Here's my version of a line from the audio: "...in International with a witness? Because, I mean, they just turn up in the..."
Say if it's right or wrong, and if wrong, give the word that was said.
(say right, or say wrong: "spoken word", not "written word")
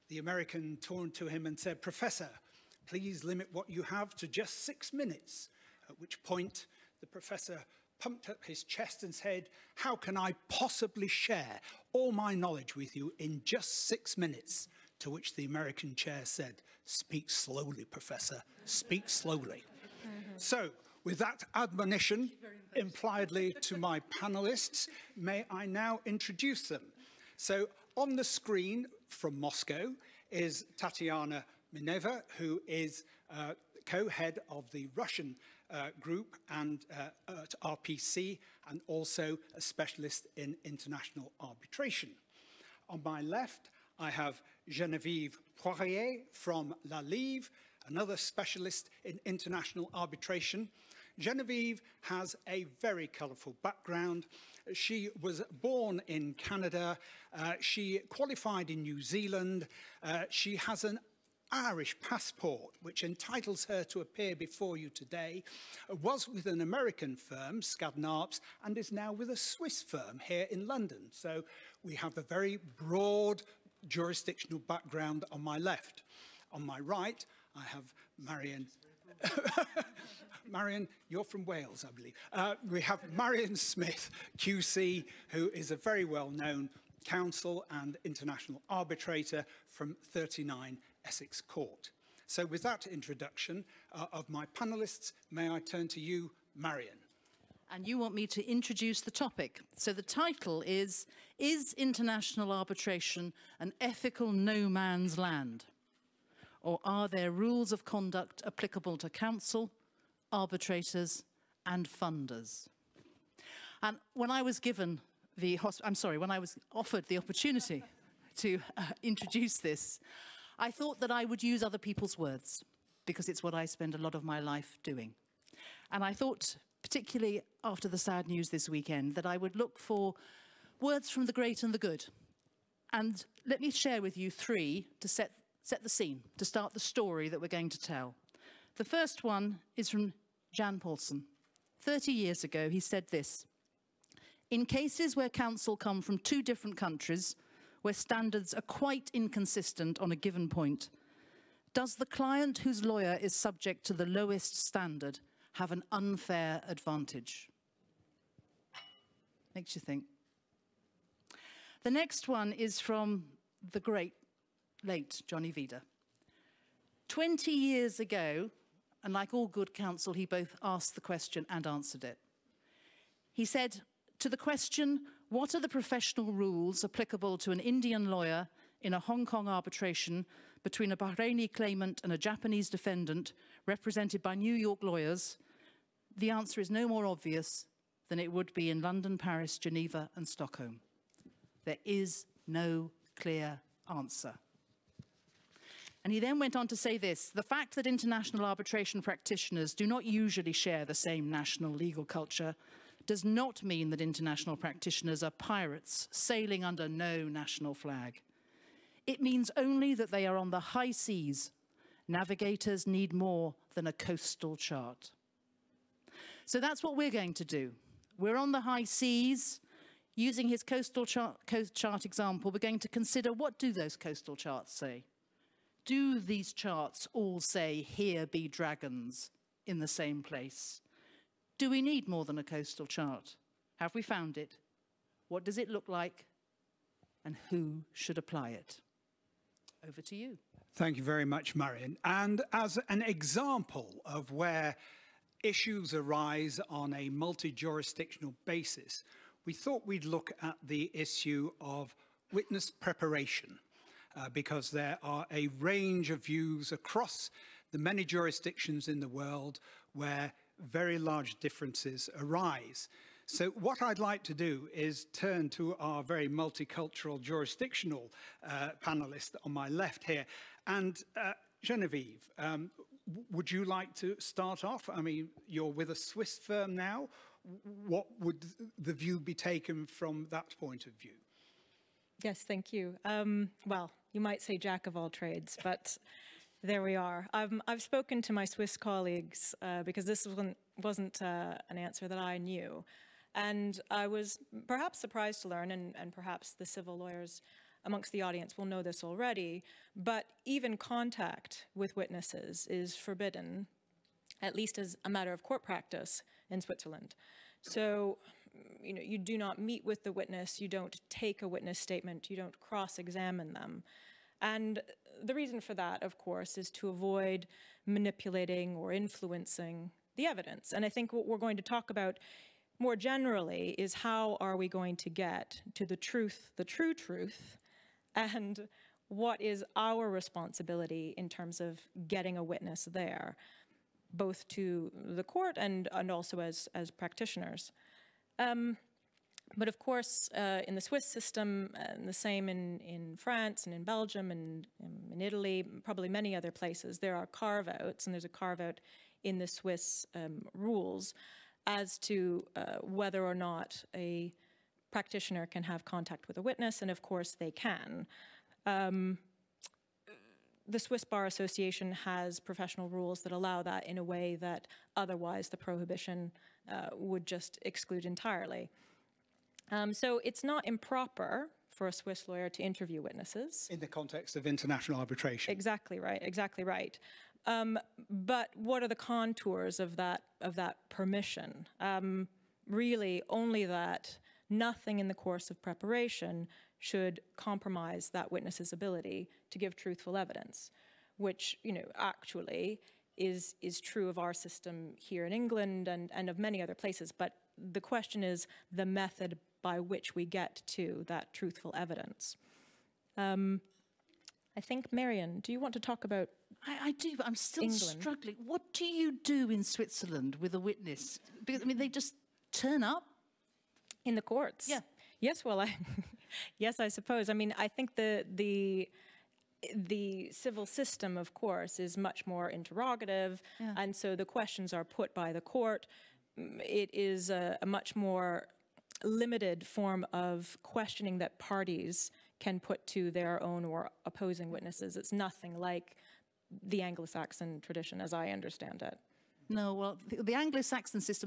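wrong: "Switzerland", not "International".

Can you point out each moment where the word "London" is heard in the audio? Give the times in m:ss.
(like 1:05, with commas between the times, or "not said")
1:10, 3:08.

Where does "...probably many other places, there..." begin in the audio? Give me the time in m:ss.
5:45.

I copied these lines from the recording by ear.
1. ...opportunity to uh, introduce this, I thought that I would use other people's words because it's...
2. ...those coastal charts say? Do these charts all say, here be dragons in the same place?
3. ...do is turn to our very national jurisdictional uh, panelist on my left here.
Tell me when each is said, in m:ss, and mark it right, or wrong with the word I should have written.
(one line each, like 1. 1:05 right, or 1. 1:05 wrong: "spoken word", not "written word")
1. 1:57 right
2. 3:43 right
3. 4:24 wrong: "multicultural", not "national".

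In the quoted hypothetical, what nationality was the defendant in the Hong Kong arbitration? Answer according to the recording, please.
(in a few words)
Japanese.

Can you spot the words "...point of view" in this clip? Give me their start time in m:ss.
4:40.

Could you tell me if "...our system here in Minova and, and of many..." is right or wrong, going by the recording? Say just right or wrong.
wrong.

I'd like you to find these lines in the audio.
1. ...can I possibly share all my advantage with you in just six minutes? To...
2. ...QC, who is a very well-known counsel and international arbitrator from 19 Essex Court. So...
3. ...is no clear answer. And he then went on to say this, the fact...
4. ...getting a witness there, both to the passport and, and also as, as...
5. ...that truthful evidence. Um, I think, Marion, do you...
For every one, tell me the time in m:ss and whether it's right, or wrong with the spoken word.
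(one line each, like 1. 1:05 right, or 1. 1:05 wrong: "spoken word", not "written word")
1. 0:09 wrong: "knowledge", not "advantage"
2. 1:24 wrong: "39", not "19"
3. 3:11 right
4. 5:32 wrong: "court", not "passport"
5. 6:41 right.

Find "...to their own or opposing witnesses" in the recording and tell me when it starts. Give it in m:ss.
7:12.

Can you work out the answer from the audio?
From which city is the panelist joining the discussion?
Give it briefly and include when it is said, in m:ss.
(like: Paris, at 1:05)
Moscow, at 0:29.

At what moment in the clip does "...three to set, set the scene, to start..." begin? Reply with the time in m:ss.
2:14.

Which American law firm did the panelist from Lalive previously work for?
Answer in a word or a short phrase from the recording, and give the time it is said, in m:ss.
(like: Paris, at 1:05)
Skadden Arps, at 1:07.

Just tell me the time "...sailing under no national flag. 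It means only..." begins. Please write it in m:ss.
3:26.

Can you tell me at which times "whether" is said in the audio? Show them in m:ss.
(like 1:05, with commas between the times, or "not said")
5:52.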